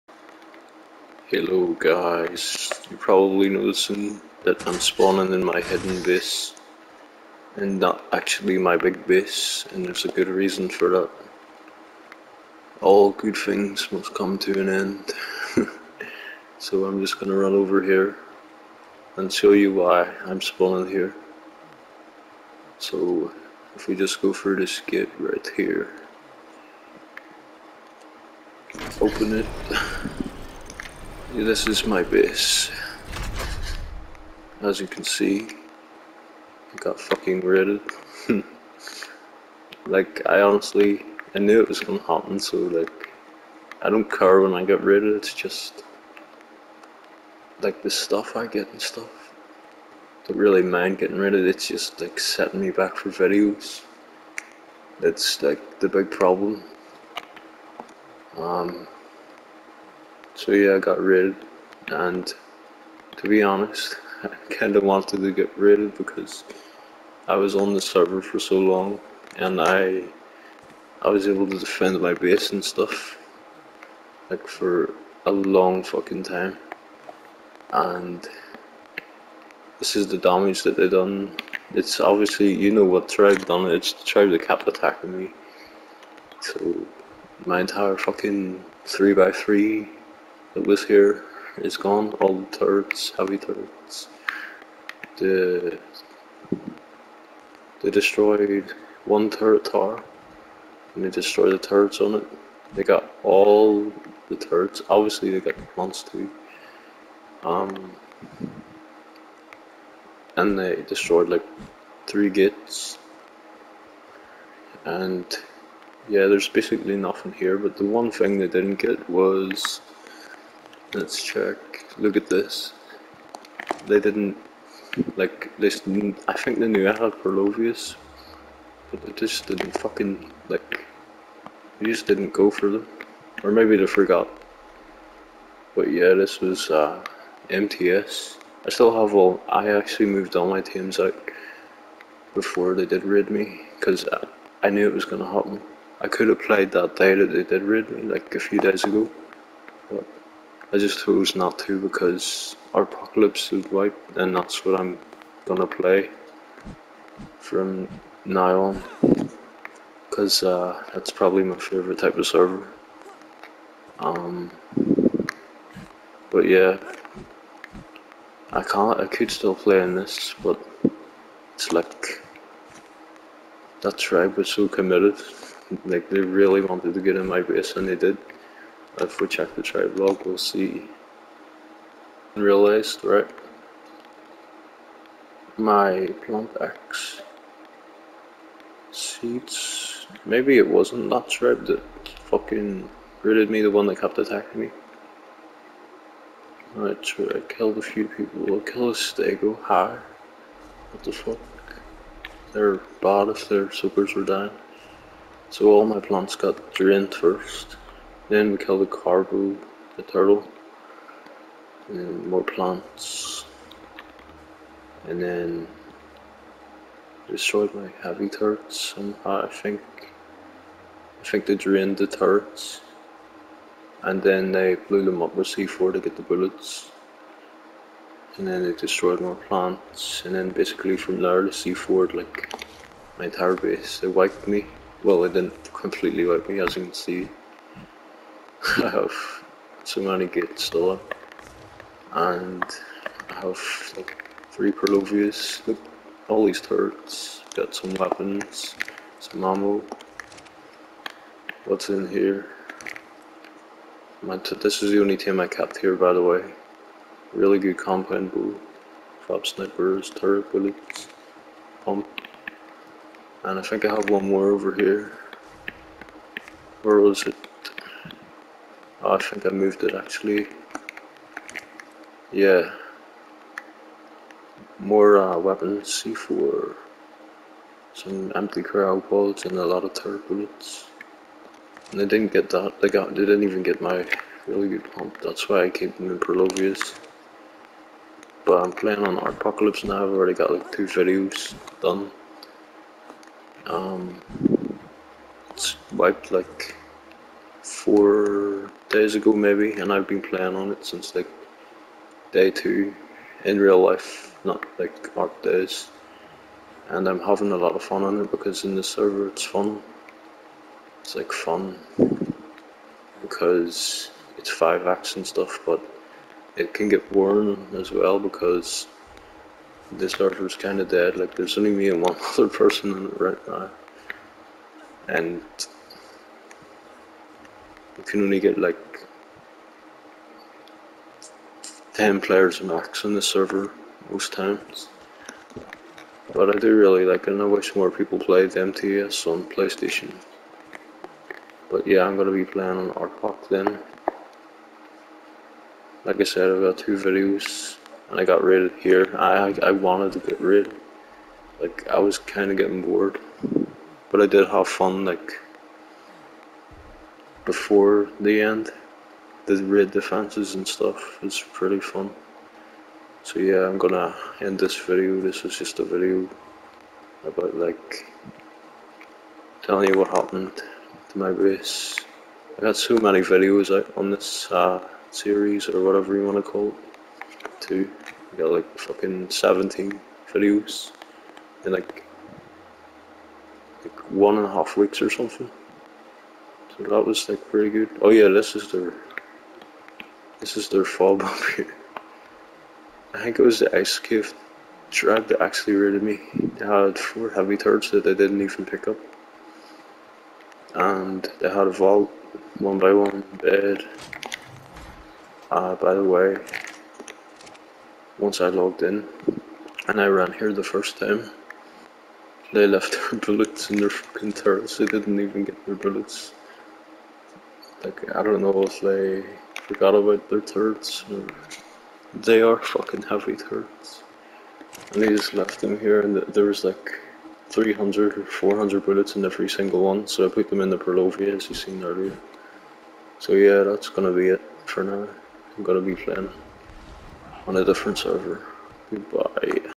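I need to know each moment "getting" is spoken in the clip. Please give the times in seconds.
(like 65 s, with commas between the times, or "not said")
50 s, 352 s.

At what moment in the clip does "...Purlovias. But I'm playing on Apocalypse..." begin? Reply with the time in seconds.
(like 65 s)
286 s.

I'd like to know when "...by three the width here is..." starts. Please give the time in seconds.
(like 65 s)
89 s.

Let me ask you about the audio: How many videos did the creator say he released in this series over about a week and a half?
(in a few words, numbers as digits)
17.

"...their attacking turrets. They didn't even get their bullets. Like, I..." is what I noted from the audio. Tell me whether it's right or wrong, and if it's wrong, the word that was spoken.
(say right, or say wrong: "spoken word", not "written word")
wrong: "fucking", not "attacking".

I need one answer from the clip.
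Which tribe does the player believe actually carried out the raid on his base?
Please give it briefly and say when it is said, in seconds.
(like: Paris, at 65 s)
ice cave drag, at 393 s.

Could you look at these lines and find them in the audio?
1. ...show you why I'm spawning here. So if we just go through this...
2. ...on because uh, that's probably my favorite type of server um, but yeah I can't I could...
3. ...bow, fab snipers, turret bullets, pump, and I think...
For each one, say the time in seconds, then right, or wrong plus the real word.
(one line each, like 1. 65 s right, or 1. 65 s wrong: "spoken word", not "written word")
1. 19 s right
2. 159 s right
3. 258 s right.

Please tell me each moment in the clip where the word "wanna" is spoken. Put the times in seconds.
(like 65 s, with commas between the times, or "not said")
376 s.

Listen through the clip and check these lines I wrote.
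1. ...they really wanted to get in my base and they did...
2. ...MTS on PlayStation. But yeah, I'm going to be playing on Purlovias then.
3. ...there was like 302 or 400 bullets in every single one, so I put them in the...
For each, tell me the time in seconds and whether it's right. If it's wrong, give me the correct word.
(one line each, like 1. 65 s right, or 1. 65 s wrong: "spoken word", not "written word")
1. 176 s right
2. 338 s wrong: "ARPOC", not "Purlovias"
3. 426 s wrong: "300", not "302".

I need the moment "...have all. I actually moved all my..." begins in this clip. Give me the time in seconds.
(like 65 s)
138 s.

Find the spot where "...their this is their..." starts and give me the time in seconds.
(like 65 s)
388 s.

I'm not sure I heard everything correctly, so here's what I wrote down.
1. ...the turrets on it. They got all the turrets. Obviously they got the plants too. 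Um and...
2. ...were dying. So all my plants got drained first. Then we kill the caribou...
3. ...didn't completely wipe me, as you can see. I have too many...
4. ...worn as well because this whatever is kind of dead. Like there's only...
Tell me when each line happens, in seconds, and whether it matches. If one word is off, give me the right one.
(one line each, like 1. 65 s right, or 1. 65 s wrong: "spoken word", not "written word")
1. 101 s right
2. 204 s right
3. 235 s right
4. 317 s wrong: "server", not "whatever".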